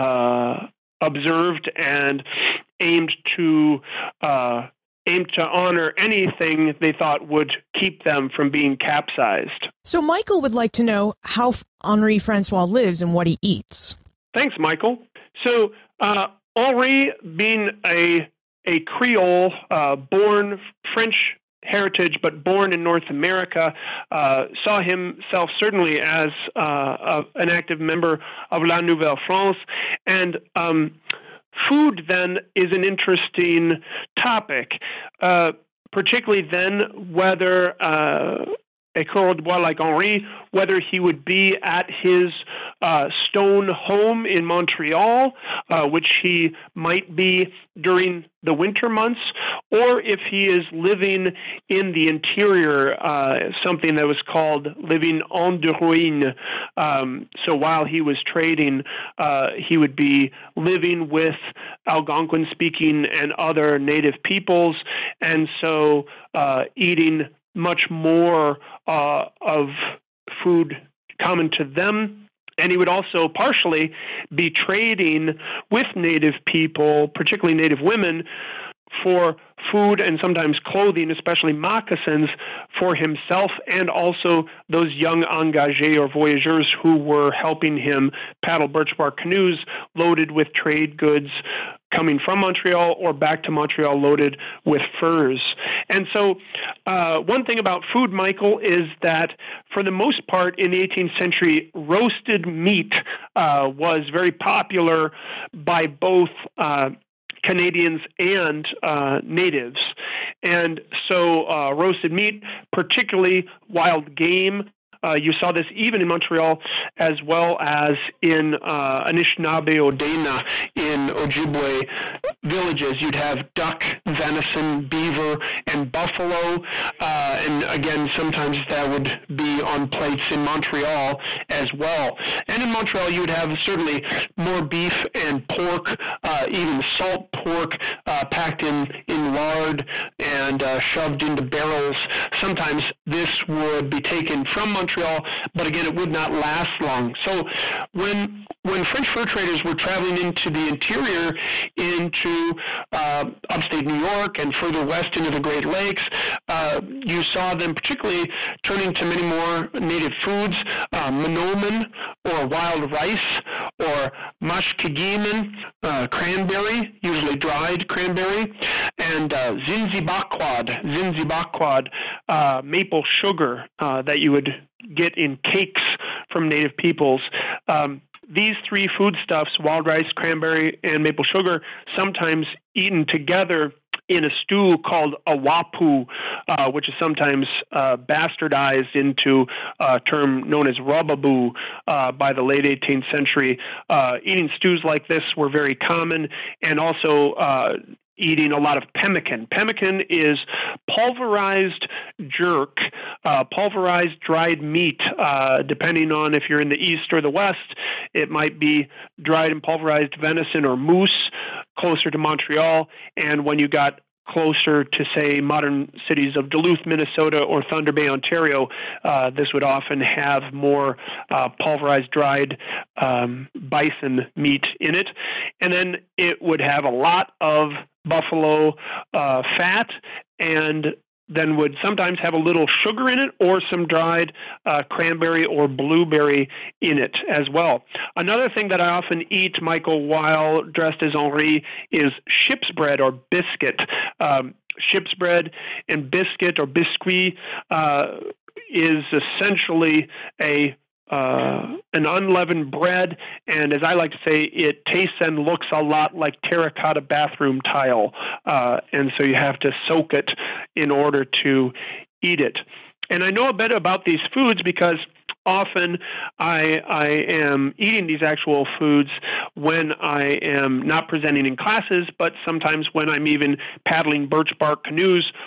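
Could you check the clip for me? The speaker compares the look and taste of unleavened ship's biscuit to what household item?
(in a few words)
terracotta bathroom tile.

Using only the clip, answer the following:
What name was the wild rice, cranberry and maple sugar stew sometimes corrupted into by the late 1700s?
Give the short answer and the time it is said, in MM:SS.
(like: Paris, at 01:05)
rubaboo, at 03:10.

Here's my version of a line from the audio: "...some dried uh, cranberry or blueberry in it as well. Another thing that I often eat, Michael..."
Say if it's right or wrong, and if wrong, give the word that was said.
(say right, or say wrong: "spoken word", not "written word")
right.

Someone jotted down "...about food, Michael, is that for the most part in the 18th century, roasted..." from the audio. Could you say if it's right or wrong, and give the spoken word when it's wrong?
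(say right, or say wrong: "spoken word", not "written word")
right.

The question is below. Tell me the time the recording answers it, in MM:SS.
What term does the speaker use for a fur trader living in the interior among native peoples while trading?
00:55.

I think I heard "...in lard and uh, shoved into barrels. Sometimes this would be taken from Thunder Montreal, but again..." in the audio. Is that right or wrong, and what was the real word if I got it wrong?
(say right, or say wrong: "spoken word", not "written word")
wrong: "Montreal", not "Thunder".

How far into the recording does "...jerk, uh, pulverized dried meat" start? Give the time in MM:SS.
03:22.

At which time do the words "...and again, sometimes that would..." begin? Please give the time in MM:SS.
02:07.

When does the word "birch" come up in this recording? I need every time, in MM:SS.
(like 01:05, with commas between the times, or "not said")
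01:28, 04:34.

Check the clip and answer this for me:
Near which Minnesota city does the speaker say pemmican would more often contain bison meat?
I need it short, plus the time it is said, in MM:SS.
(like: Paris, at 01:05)
Duluth, at 03:36.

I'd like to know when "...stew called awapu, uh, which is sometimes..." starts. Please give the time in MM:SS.
03:04.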